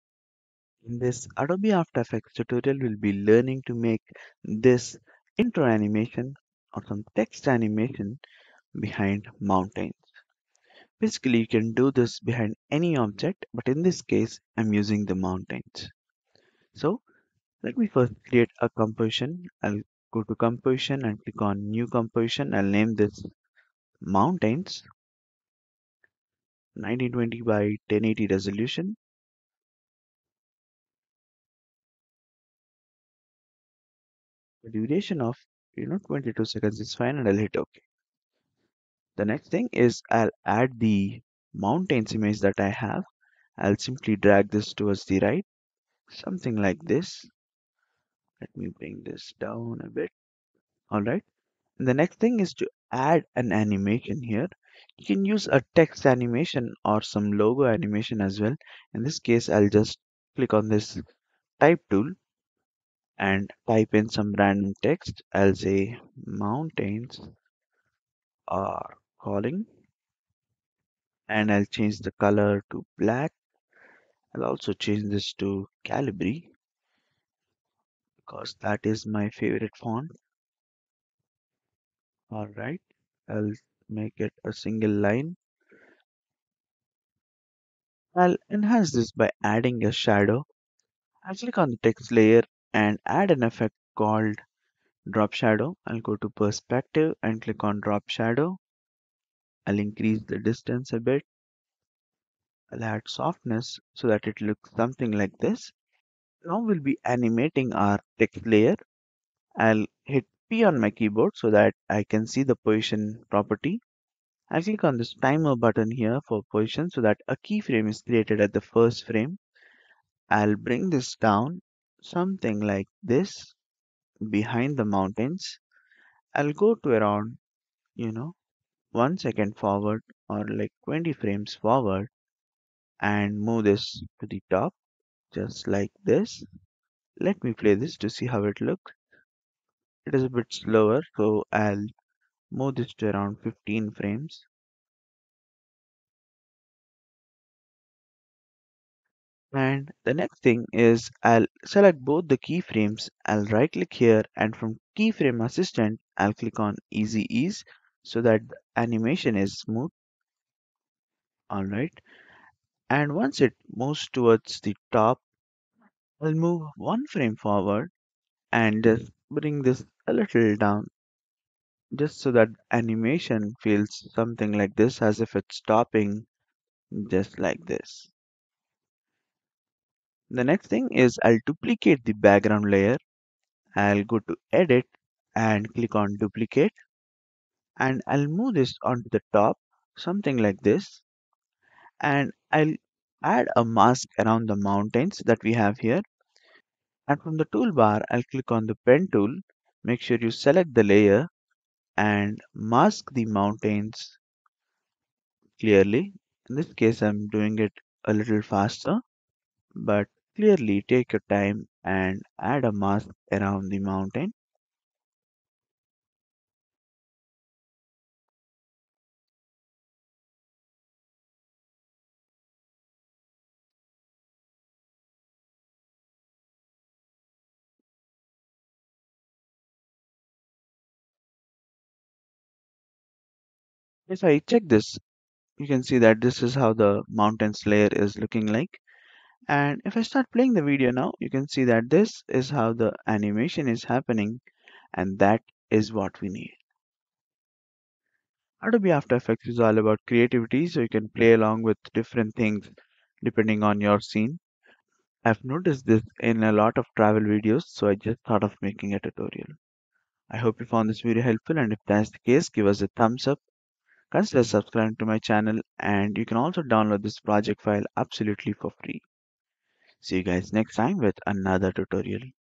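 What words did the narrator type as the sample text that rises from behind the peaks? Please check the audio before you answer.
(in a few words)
mountains are calling.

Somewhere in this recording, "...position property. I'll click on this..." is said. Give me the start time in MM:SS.
01:52.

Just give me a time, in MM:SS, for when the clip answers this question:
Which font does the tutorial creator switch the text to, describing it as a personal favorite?
01:15.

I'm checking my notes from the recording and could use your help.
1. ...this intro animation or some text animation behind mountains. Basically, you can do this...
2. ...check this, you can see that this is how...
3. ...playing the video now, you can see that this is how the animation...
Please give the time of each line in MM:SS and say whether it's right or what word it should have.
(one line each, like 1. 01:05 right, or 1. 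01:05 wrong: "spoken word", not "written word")
1. 00:04 right
2. 03:54 right
3. 04:00 right.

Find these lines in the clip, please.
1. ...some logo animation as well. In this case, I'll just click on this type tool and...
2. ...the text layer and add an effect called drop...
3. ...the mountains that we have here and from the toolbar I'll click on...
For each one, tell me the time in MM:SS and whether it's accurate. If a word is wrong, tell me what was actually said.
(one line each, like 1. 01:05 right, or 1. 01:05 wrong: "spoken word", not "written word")
1. 00:57 right
2. 01:31 right
3. 03:14 right.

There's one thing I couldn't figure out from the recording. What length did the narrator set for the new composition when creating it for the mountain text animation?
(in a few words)
22 seconds.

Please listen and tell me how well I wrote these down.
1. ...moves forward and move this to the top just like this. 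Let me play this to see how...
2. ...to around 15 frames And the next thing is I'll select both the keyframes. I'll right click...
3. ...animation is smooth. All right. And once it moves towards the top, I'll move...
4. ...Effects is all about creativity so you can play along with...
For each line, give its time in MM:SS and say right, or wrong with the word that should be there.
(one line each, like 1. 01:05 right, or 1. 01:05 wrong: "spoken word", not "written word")
1. 02:11 wrong: "frames", not "moves"
2. 02:22 right
3. 02:38 right
4. 04:09 right.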